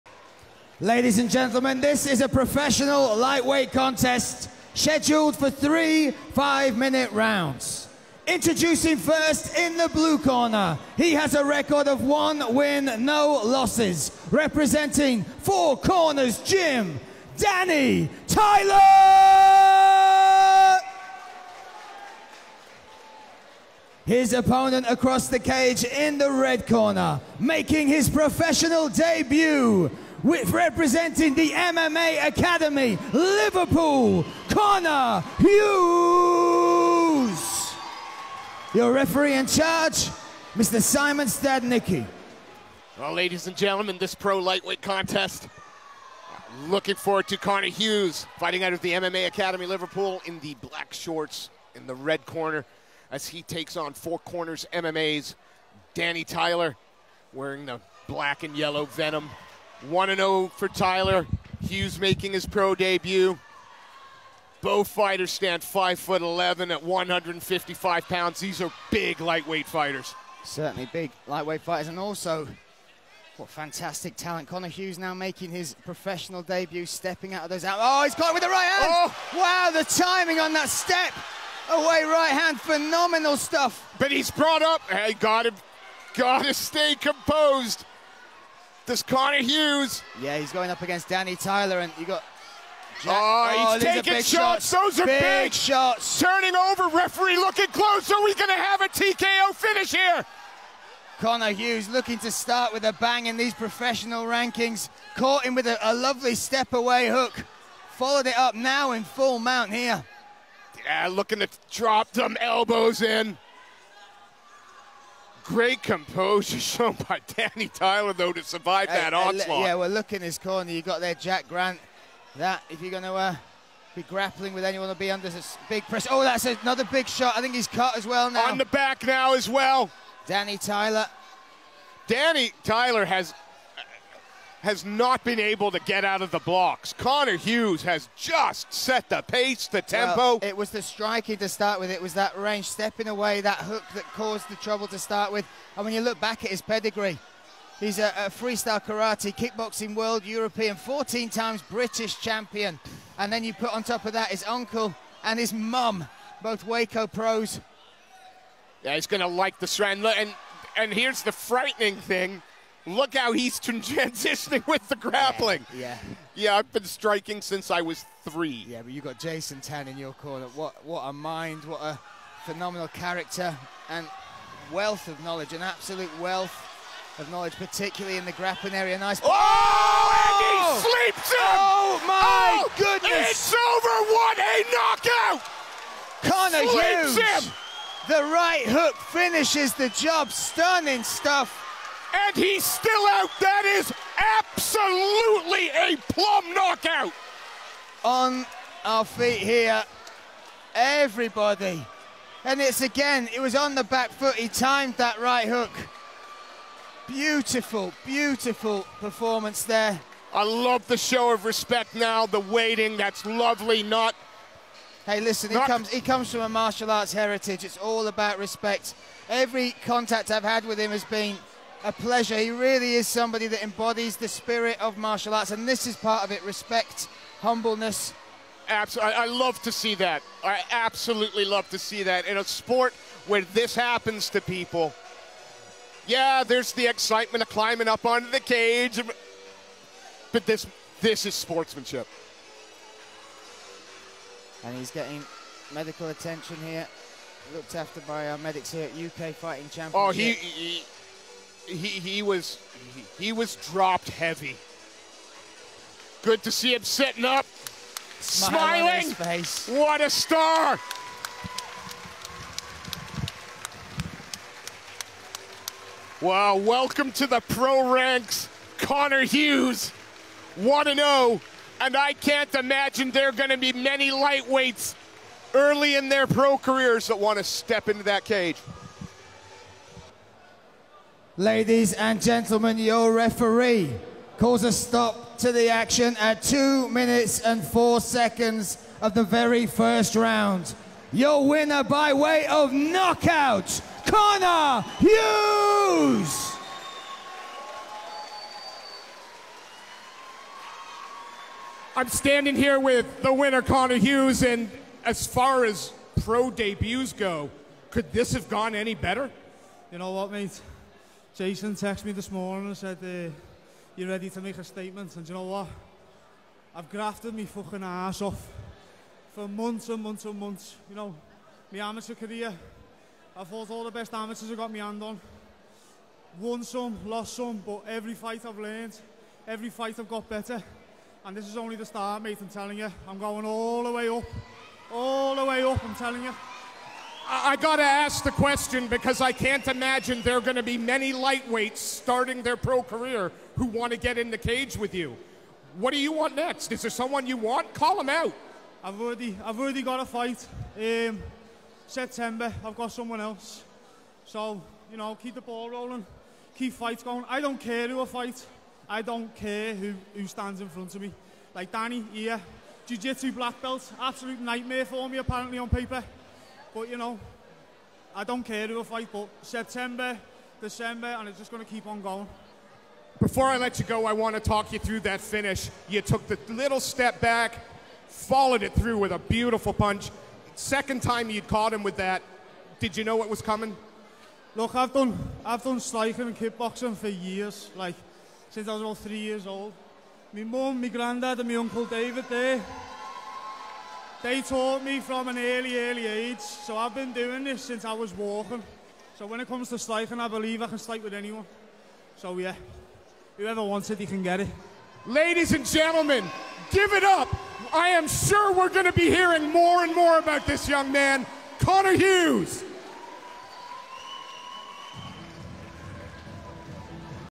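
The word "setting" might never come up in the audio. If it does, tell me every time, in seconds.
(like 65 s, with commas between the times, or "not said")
not said.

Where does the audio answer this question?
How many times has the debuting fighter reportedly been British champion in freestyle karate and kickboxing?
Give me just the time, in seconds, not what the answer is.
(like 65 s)
150 s.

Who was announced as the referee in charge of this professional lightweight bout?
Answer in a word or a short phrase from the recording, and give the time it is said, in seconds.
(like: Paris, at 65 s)
Simon Stadnicki, at 40 s.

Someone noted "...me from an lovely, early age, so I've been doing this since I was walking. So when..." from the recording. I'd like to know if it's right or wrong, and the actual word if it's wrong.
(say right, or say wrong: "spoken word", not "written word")
wrong: "early", not "lovely".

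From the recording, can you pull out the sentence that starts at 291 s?
Your winner by way of knockout, Connor Hughes!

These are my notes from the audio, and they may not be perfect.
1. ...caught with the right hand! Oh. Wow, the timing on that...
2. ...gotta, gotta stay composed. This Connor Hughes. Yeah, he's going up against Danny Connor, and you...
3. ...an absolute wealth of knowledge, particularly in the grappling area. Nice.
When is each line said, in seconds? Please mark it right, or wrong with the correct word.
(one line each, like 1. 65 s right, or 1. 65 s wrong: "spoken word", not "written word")
1. 78 s right
2. 85 s wrong: "Tyler", not "Connor"
3. 175 s right.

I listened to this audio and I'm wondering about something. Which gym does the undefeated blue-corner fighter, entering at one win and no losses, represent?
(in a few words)
Four Corners Gym.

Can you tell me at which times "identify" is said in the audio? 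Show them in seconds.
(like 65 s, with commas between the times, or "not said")
not said.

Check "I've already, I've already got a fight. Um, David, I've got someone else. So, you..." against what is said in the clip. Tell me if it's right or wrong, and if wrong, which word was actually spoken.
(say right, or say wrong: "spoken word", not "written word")
wrong: "September", not "David".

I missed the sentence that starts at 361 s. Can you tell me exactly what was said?
Like Danny here, Jiu-Jitsu black belt, absolute nightmare for me apparently on paper.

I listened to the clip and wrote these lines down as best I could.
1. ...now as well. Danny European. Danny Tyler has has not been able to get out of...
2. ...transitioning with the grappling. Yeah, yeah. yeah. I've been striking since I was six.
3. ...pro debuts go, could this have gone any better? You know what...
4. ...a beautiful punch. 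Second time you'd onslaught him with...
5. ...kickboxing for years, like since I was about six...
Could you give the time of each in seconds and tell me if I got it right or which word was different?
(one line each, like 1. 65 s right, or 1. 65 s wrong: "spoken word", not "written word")
1. 129 s wrong: "Tyler", not "European"
2. 163 s wrong: "three", not "six"
3. 306 s right
4. 379 s wrong: "caught", not "onslaught"
5. 386 s wrong: "three", not "six".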